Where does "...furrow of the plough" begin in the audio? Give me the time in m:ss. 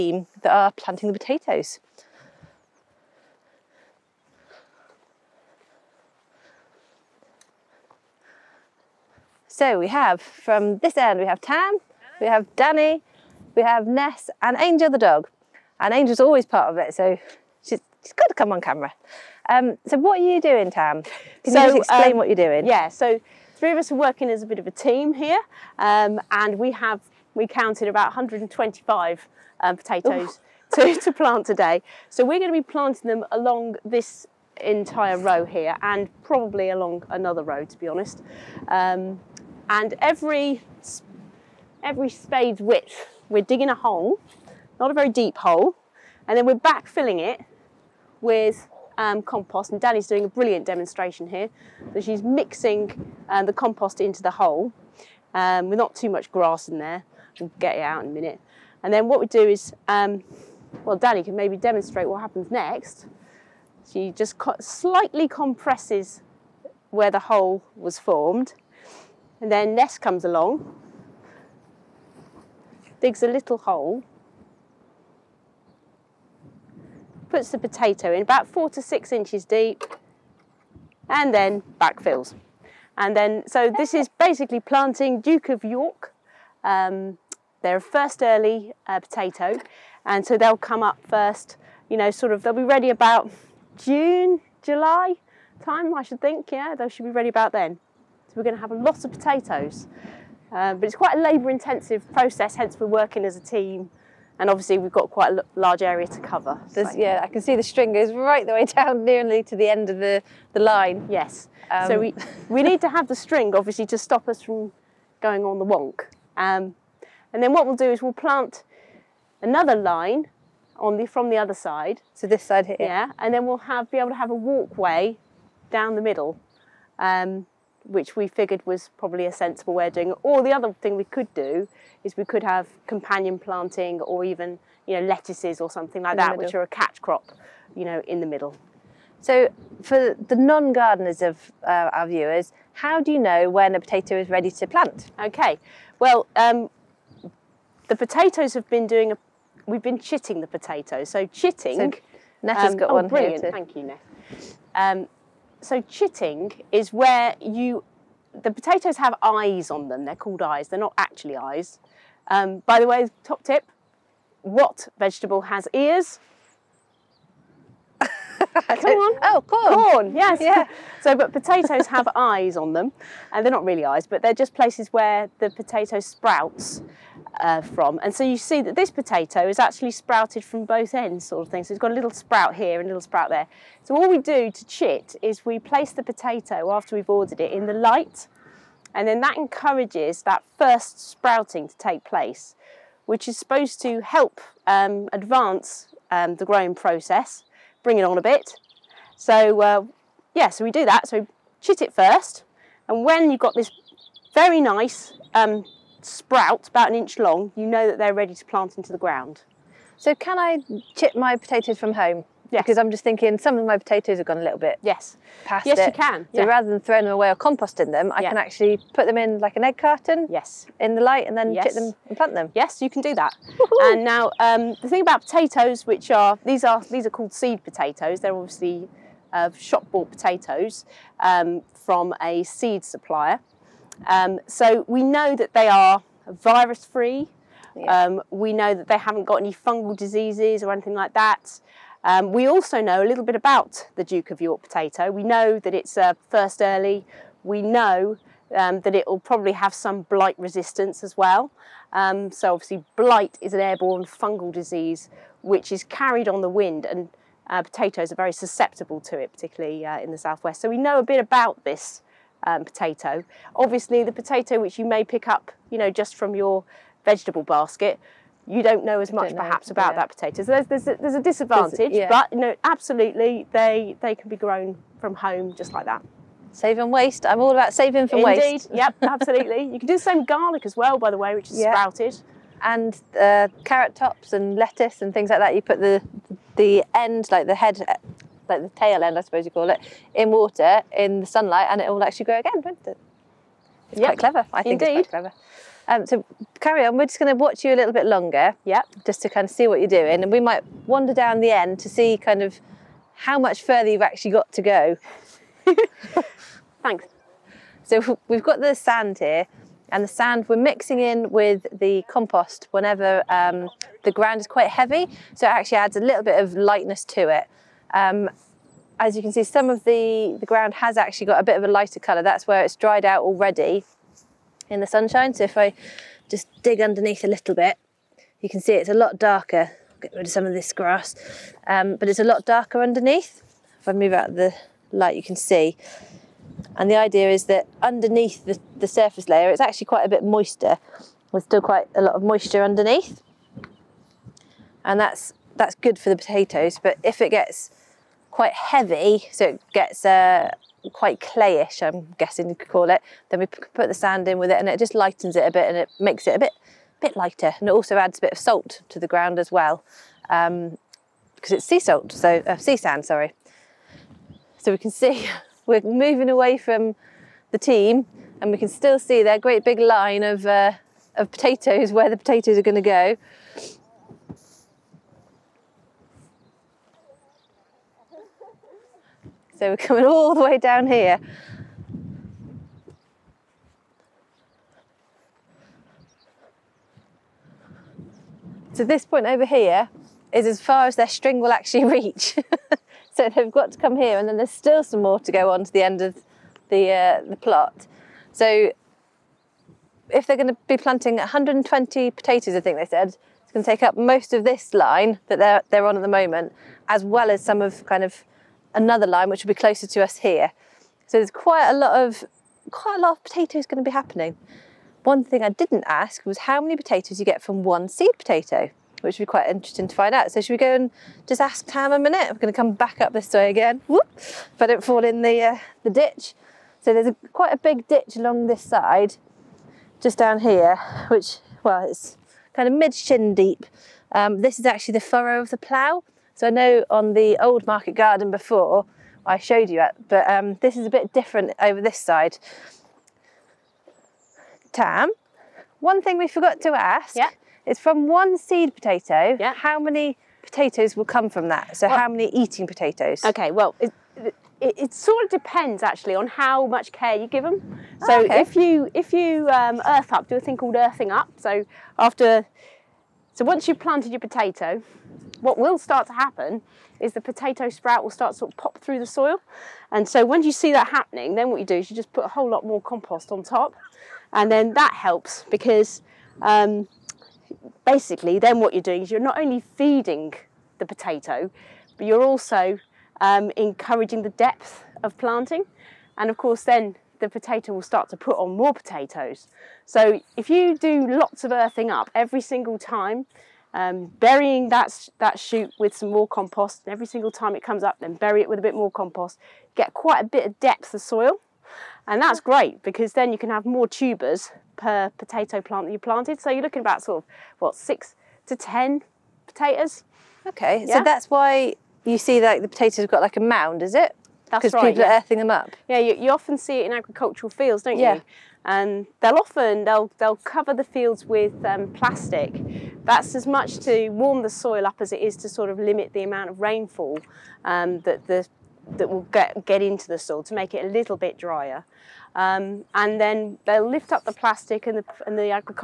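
7:14.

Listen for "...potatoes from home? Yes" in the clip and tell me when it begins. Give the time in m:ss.
3:31.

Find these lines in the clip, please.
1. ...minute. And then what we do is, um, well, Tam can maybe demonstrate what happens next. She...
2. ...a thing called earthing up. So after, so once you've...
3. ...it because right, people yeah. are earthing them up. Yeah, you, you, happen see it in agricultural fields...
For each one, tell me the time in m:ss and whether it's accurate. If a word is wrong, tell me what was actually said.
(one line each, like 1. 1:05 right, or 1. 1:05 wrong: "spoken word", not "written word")
1. 0:58 wrong: "Danny", not "Tam"
2. 7:40 right
3. 8:33 wrong: "often", not "happen".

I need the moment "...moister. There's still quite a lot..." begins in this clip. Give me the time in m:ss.
5:40.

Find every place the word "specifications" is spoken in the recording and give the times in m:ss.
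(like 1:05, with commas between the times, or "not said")
not said.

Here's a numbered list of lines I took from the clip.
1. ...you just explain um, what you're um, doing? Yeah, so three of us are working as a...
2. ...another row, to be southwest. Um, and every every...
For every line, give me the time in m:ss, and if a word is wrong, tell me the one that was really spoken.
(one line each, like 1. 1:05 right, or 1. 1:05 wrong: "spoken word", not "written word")
1. 0:21 right
2. 0:37 wrong: "honest", not "southwest".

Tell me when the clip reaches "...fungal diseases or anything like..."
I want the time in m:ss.
3:59.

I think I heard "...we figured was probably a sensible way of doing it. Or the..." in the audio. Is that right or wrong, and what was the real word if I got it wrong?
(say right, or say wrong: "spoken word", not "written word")
right.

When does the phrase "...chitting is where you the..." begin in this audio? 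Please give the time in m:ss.
2:35.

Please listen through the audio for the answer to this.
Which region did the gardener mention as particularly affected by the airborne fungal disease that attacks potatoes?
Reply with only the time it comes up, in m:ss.
4:20.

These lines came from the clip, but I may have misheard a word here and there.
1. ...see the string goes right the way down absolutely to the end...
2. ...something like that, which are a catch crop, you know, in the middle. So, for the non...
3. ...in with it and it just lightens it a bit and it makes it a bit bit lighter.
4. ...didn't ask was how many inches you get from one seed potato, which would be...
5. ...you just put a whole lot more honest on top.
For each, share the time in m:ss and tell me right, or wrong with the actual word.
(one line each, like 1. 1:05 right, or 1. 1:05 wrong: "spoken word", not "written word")
1. 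1:47 wrong: "nearly", not "absolutely"
2. 2:15 right
3. 5:54 right
4. 6:55 wrong: "potatoes", not "inches"
5. 7:51 wrong: "compost", not "honest".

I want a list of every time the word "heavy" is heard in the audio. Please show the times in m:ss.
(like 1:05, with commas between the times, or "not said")
5:14, 5:48.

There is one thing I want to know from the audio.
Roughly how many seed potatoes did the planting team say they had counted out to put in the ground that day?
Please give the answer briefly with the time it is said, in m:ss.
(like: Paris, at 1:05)
125, at 0:28.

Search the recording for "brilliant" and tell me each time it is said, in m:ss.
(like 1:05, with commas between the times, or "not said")
0:50, 2:33.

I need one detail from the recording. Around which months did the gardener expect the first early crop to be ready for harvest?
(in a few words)
June, July.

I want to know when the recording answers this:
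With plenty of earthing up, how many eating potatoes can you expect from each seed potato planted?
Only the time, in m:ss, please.
8:27.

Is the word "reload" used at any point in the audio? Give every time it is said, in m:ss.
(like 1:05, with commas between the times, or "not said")
not said.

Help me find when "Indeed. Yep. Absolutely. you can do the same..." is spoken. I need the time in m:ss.
4:38.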